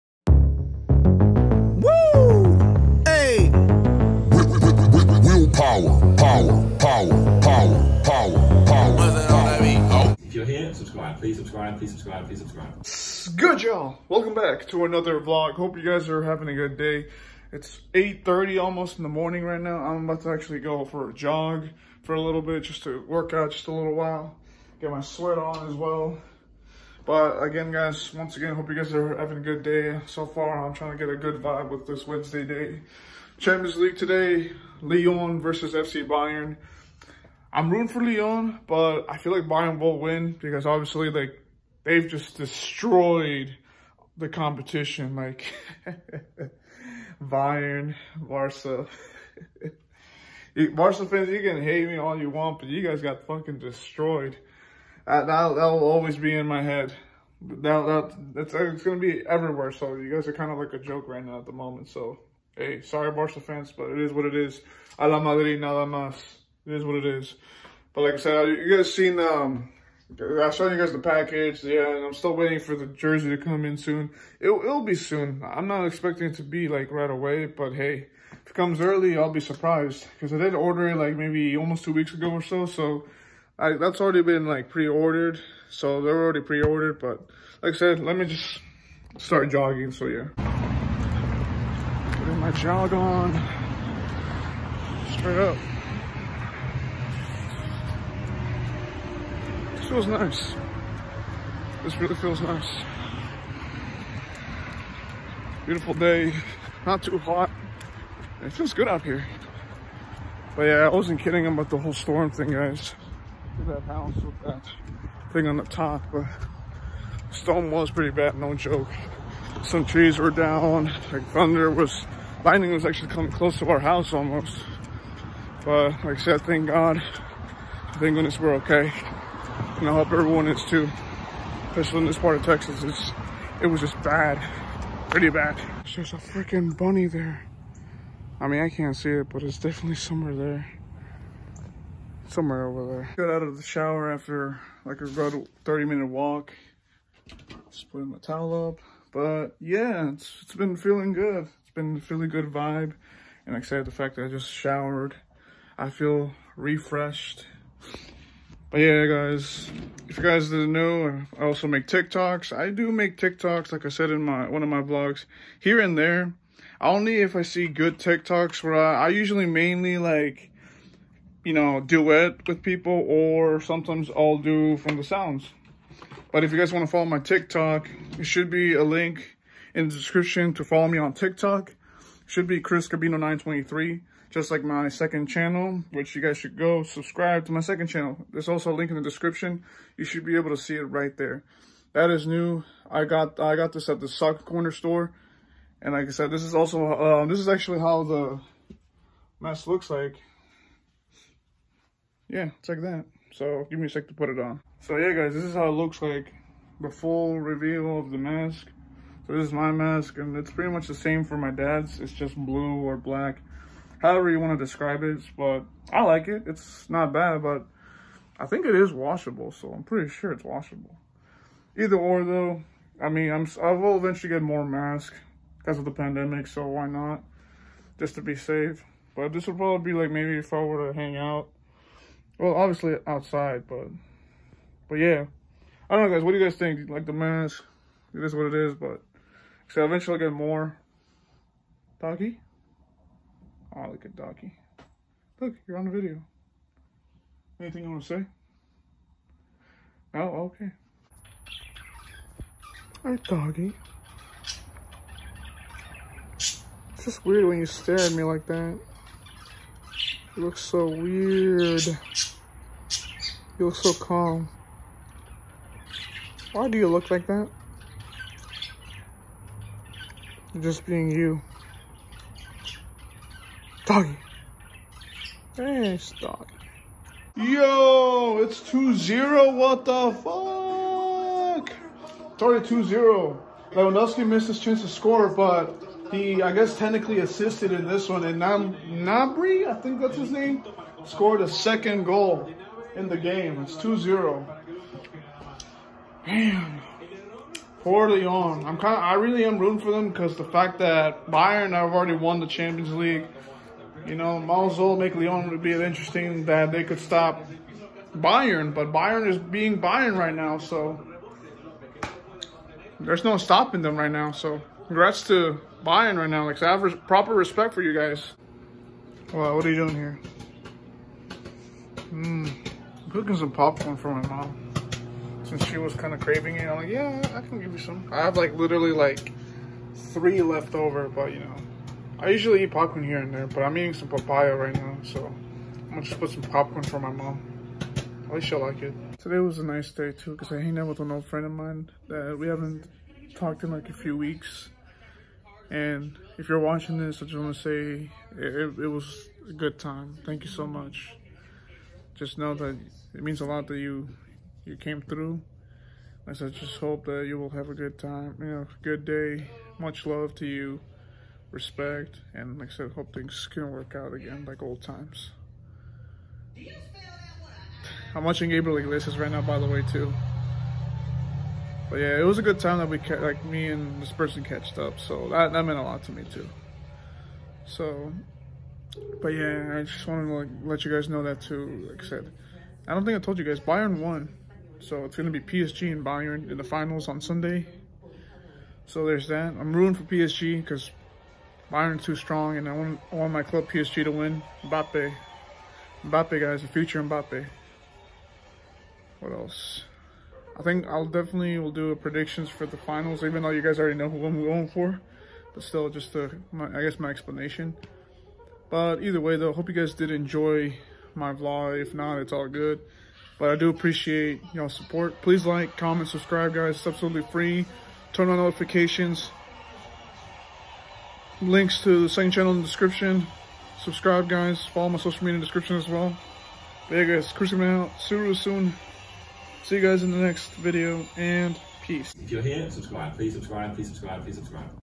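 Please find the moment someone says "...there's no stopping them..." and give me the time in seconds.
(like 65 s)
312 s.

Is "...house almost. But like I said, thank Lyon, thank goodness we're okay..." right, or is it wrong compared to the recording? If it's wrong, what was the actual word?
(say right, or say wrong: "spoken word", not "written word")
wrong: "God", not "Lyon".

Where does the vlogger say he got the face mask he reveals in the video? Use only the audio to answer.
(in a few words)
The sock corner store.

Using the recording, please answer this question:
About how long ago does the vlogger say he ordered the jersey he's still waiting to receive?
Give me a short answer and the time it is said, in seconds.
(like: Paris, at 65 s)
2 weeks, at 81 s.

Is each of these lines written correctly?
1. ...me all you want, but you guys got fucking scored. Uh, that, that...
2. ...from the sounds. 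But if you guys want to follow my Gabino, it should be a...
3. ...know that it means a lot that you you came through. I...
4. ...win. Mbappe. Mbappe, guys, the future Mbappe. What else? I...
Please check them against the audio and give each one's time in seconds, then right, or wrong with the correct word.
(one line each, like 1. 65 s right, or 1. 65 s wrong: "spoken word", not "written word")
1. 51 s wrong: "destroyed", not "scored"
2. 174 s wrong: "TikTok", not "Gabino"
3. 352 s right
4. 394 s right.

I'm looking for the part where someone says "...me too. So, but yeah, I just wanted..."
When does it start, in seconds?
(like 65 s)
376 s.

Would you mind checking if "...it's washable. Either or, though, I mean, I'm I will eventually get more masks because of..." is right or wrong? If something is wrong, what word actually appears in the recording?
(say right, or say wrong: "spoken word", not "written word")
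right.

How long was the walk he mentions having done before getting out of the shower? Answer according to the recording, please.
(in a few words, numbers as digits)
30 minutes.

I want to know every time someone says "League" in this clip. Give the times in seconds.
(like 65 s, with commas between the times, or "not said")
33 s, 302 s.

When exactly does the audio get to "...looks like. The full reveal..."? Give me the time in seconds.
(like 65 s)
205 s.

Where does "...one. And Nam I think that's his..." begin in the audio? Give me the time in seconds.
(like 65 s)
288 s.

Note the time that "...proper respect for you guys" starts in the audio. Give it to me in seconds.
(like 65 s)
317 s.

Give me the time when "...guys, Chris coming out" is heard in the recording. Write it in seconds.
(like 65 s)
427 s.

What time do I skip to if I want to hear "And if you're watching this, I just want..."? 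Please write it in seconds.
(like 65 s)
345 s.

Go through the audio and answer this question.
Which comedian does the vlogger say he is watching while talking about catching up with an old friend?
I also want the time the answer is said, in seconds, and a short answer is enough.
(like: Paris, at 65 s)
Gabriel Iglesias, at 368 s.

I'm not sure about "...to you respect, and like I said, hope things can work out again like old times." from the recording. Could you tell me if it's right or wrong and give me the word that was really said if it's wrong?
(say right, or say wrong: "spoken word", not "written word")
right.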